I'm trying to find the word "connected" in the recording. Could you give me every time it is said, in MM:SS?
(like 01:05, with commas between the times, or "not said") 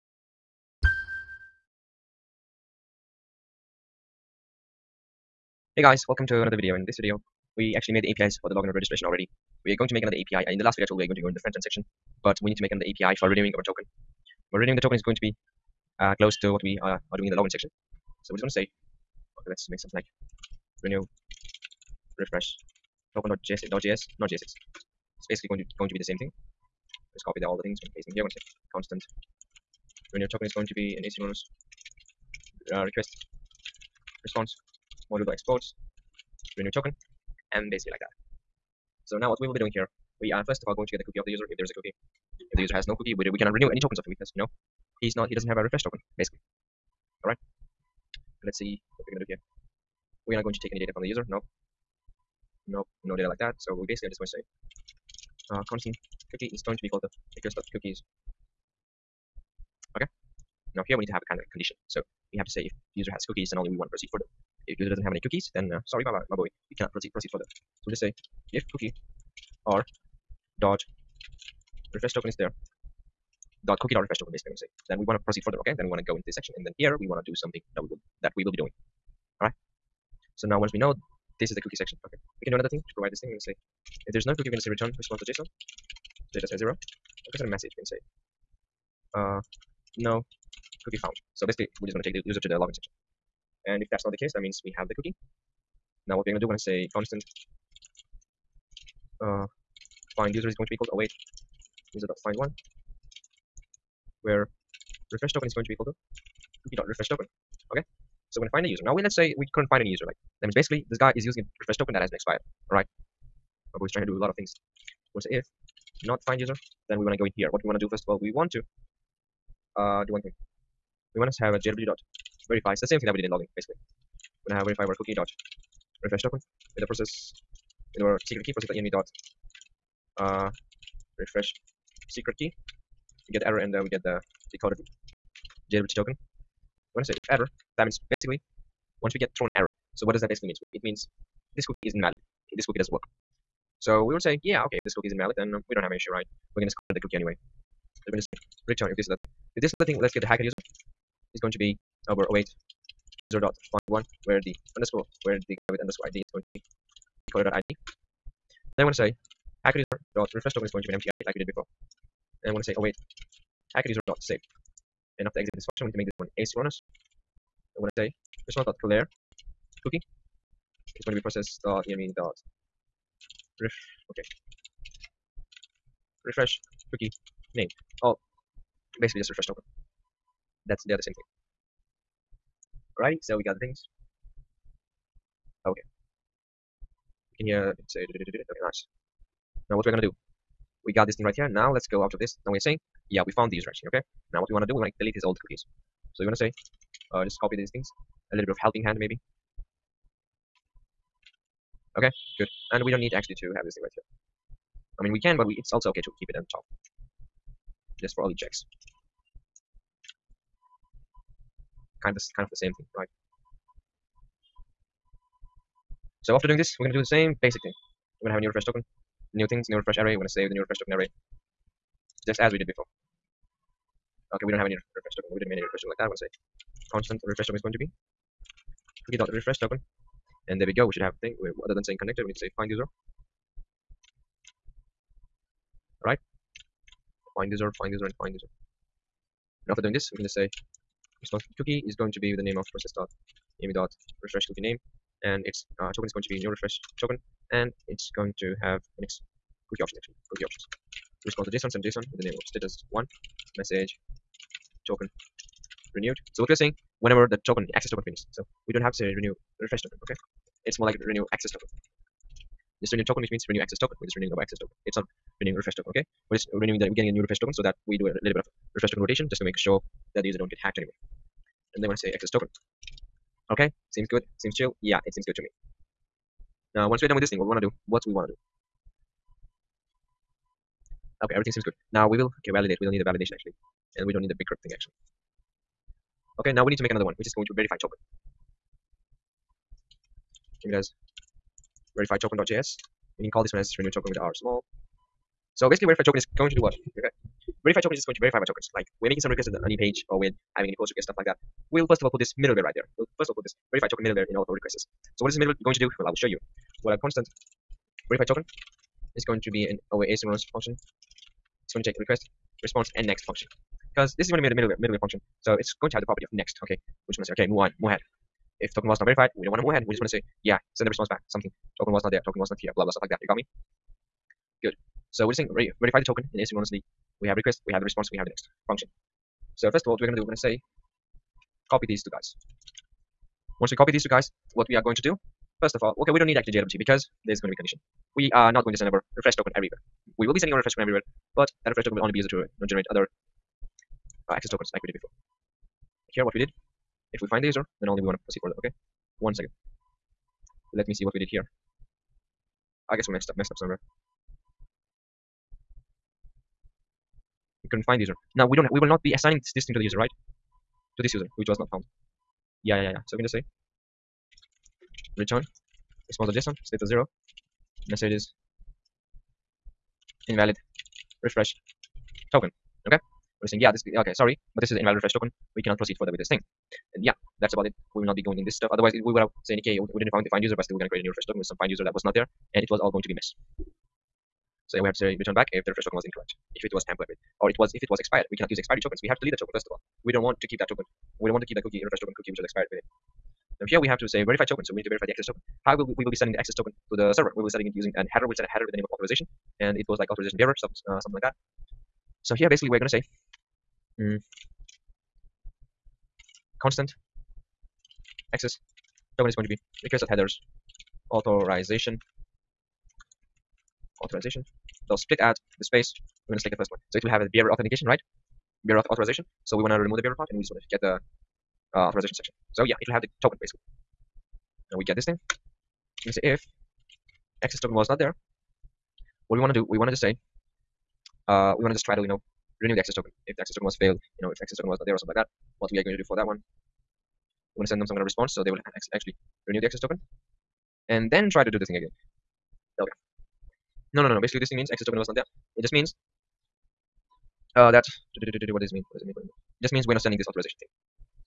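03:52.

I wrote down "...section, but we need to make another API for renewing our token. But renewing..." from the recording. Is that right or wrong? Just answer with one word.
right.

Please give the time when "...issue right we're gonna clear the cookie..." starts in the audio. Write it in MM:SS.
02:25.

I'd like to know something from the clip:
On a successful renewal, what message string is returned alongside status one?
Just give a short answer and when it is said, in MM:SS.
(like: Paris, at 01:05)
token renewed, at 04:14.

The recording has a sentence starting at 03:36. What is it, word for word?
So after doing this, we're gonna do the same basic thing.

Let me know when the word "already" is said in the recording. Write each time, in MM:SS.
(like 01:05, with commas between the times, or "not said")
00:09.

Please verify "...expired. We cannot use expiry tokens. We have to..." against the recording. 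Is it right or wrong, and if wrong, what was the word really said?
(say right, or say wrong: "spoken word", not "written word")
right.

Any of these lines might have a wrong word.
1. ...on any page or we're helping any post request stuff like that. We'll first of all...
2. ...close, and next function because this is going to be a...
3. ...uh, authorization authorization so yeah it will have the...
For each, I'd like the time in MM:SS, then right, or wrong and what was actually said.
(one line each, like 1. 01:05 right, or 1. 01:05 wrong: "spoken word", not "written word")
1. 04:59 wrong: "having", not "helping"
2. 05:12 wrong: "response", not "close"
3. 07:01 wrong: "section", not "authorization".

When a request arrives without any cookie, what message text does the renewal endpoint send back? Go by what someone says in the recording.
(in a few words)
no cookie found.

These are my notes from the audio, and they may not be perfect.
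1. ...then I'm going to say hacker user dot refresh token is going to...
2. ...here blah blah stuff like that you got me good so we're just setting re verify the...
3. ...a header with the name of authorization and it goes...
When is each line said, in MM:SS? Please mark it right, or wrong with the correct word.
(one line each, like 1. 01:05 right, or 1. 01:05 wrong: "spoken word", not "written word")
1. 02:38 right
2. 05:22 wrong: "saying", not "setting"
3. 06:38 right.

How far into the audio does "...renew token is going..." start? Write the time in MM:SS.
00:30.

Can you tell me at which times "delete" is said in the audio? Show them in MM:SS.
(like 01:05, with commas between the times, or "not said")
03:14, 06:29.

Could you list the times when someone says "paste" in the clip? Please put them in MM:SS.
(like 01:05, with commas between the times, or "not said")
00:27.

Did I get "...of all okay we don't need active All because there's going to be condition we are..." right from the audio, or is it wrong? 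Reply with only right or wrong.
wrong.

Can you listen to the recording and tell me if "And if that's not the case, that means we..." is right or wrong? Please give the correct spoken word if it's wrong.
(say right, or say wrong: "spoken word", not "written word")
right.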